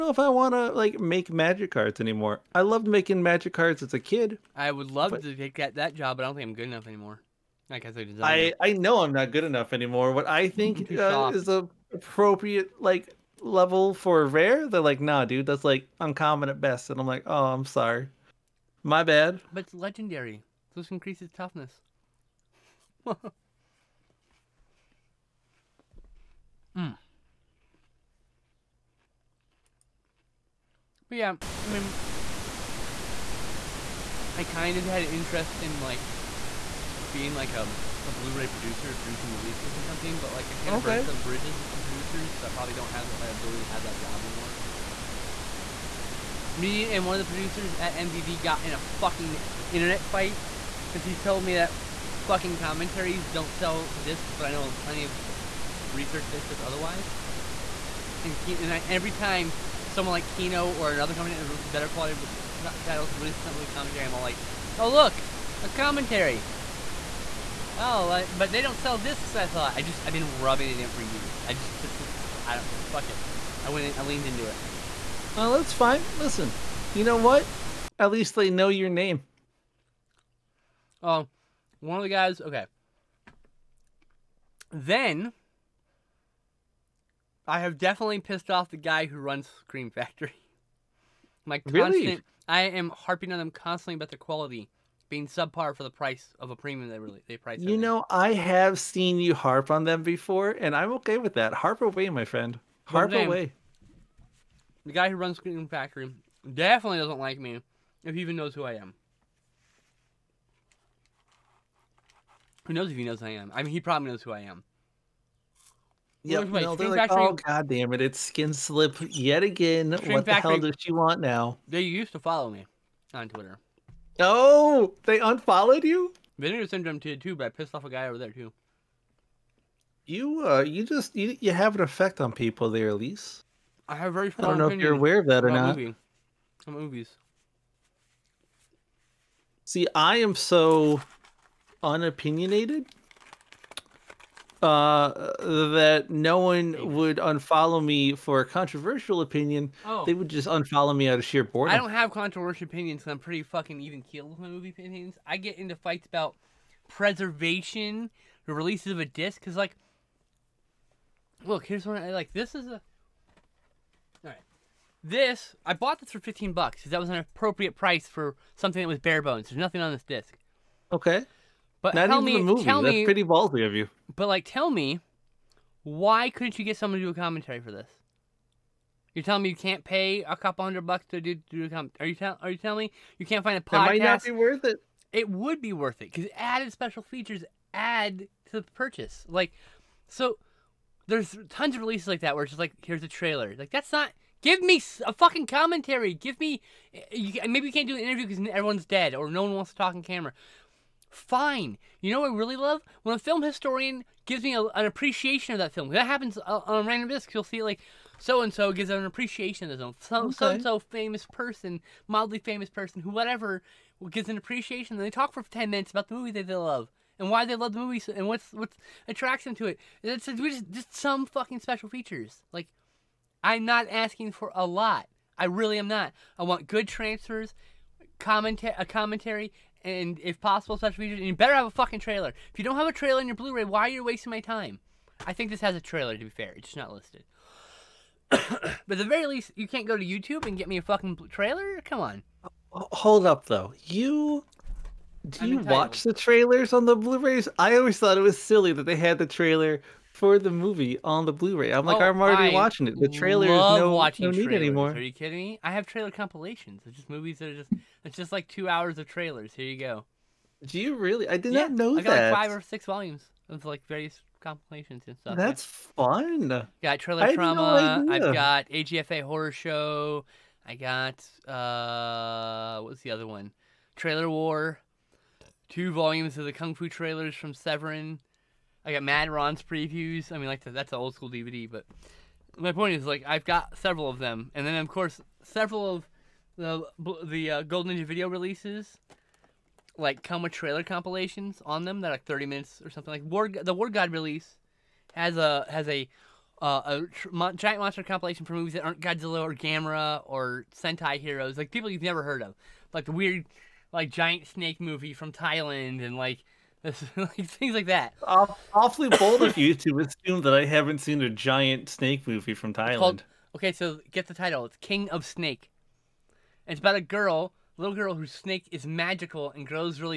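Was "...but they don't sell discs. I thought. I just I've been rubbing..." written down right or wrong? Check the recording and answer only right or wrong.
right.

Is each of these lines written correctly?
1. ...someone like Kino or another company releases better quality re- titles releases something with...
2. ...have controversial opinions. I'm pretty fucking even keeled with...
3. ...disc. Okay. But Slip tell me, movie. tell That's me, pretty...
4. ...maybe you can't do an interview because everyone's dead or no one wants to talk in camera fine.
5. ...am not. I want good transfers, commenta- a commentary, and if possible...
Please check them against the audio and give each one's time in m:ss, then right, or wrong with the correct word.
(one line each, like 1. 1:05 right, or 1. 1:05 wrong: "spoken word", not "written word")
1. 0:59 right
2. 2:31 right
3. 2:50 wrong: "Not", not "Slip"
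4. 3:17 right
5. 3:45 right.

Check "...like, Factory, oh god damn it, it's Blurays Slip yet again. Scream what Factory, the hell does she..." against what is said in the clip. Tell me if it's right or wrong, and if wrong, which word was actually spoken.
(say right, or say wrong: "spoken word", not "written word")
wrong: "Skin", not "Blurays".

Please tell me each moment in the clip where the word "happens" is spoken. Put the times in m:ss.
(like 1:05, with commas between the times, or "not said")
3:26.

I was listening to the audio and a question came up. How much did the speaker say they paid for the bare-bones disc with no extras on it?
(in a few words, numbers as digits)
15 dollars.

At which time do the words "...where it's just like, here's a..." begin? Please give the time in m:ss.
3:12.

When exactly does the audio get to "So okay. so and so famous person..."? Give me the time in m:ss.
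3:29.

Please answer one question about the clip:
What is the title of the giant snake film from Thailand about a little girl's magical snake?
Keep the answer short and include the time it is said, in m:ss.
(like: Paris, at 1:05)
King of Snake, at 5:14.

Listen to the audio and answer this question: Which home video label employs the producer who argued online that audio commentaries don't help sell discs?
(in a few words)
MVD.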